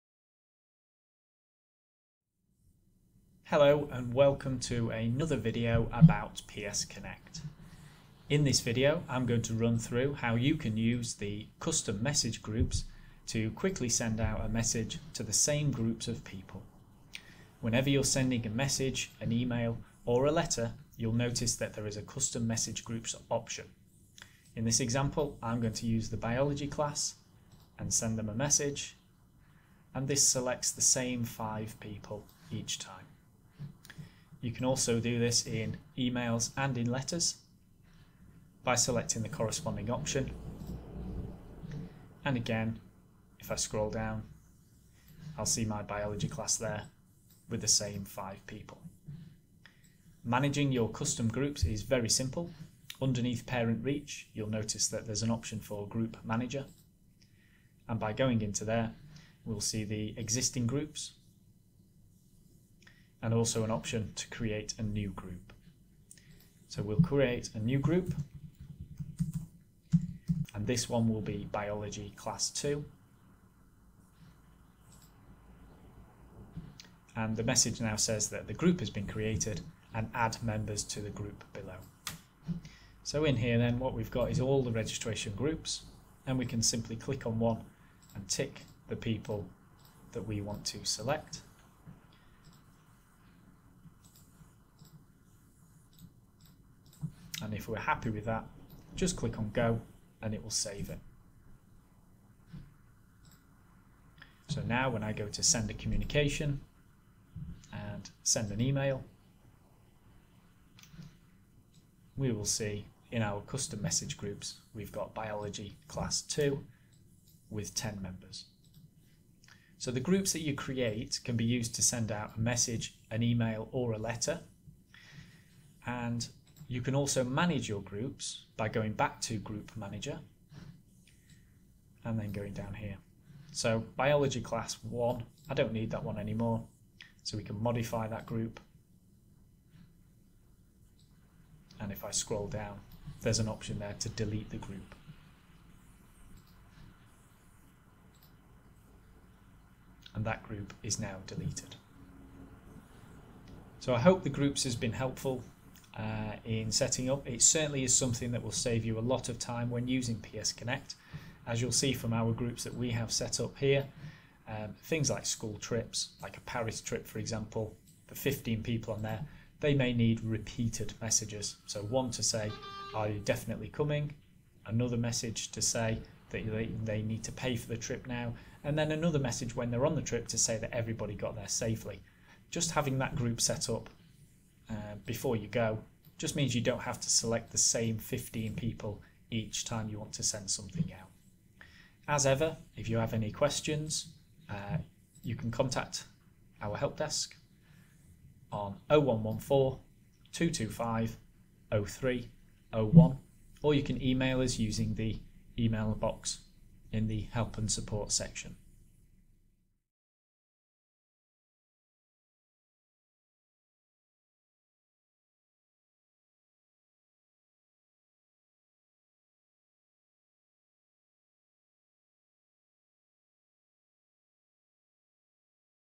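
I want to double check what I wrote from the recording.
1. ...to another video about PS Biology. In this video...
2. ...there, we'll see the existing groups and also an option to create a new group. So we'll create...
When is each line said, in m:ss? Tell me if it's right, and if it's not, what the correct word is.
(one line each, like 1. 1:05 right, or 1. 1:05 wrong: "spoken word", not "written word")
1. 0:04 wrong: "Connect", not "Biology"
2. 0:58 right.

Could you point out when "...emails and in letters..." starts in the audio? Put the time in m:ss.
0:35.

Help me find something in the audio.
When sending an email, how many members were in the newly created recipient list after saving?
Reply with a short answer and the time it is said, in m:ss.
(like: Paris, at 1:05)
10, at 1:57.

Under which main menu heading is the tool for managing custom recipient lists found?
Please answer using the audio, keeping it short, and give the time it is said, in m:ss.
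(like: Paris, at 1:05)
Parent Reach, at 0:53.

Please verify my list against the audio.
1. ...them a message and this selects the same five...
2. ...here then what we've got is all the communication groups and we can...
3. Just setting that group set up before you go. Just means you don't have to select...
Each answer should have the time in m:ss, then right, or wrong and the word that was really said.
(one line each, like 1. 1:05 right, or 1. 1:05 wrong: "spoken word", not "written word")
1. 0:28 right
2. 1:23 wrong: "registration", not "communication"
3. 3:02 wrong: "having", not "setting".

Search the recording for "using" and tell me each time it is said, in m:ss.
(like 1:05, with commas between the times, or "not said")
2:39, 3:24.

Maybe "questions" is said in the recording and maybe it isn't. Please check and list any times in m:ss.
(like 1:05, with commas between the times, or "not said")
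3:13.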